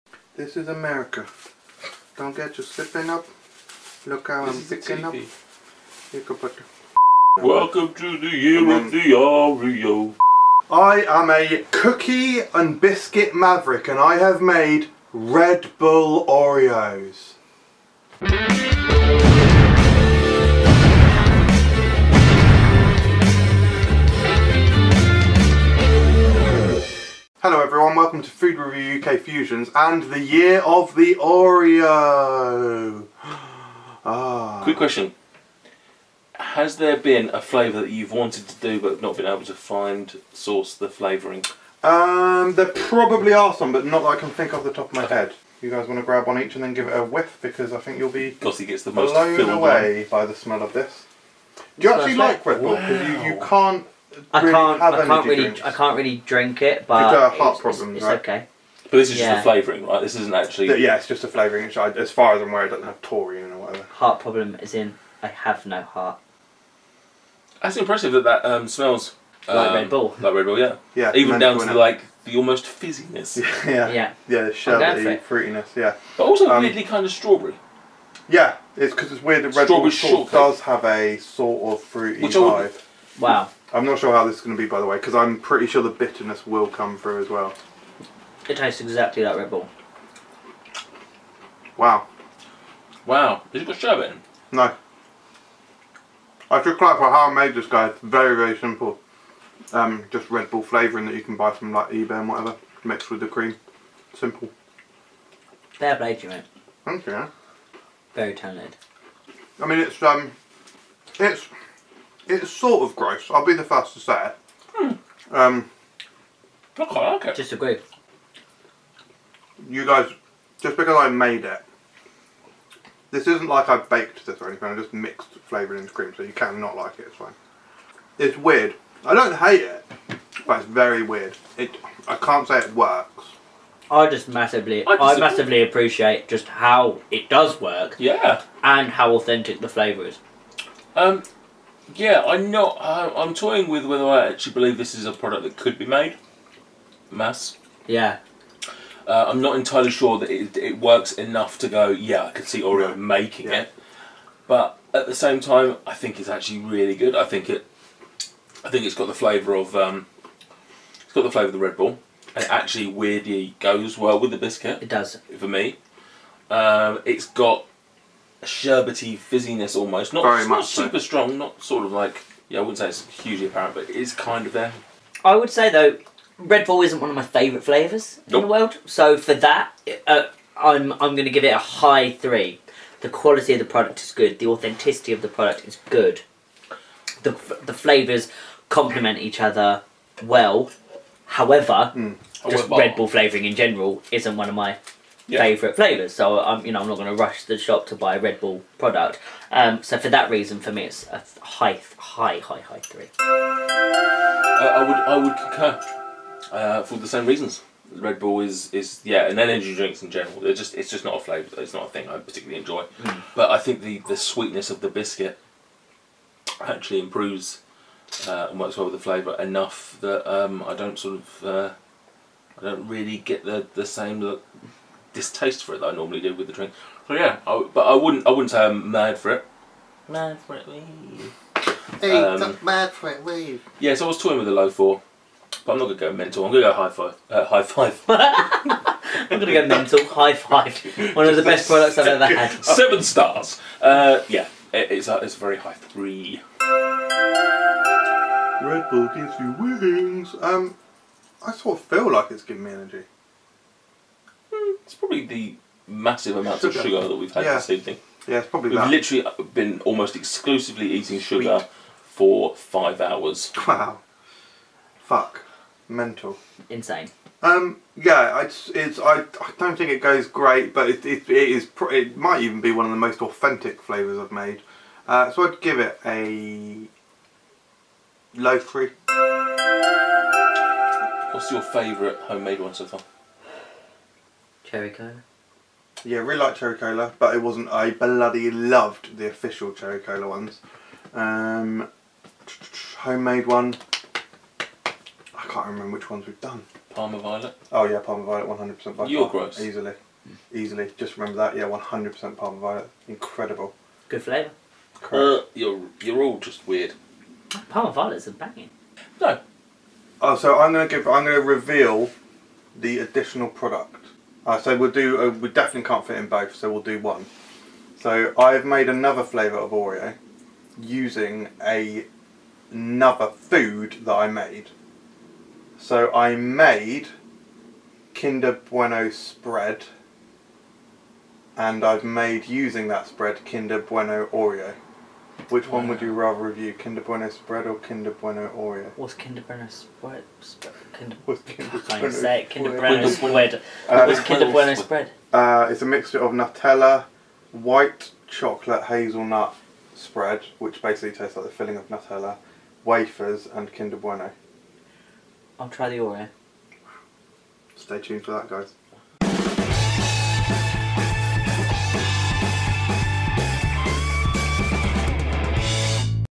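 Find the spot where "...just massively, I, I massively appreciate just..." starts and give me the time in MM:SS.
02:14.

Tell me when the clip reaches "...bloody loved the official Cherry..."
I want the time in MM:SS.
04:47.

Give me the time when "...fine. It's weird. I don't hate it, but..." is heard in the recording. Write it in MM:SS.
02:07.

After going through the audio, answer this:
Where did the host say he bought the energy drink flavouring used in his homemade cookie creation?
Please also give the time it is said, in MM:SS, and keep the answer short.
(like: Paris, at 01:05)
eBay, at 01:41.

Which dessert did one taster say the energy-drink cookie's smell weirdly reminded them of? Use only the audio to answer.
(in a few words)
Strawberry shortcake.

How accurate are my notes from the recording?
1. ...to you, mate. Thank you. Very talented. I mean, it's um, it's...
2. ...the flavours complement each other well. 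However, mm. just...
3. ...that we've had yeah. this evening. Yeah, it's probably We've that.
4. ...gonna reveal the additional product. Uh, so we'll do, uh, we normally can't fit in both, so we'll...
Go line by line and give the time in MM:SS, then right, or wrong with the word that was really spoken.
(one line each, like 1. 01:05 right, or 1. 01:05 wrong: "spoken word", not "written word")
1. 01:46 right
2. 03:07 right
3. 04:17 right
4. 05:11 wrong: "definitely", not "normally".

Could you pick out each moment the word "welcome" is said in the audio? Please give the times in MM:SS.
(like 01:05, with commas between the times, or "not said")
00:07, 00:28.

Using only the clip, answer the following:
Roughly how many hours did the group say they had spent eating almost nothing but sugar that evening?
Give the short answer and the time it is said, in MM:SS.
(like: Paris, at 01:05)
5, at 04:22.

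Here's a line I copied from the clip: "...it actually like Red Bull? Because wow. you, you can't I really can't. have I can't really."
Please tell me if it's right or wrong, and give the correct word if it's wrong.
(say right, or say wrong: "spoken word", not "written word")
right.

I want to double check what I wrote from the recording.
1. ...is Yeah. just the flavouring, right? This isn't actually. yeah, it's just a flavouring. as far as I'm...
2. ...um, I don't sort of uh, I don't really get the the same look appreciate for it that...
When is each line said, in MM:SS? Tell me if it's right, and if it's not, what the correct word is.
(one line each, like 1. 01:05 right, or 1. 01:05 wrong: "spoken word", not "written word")
1. 00:59 right
2. 03:40 wrong: "distaste", not "appreciate".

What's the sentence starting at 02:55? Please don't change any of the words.
I would say though, Red Bull isn't one of my favourite flavours nope.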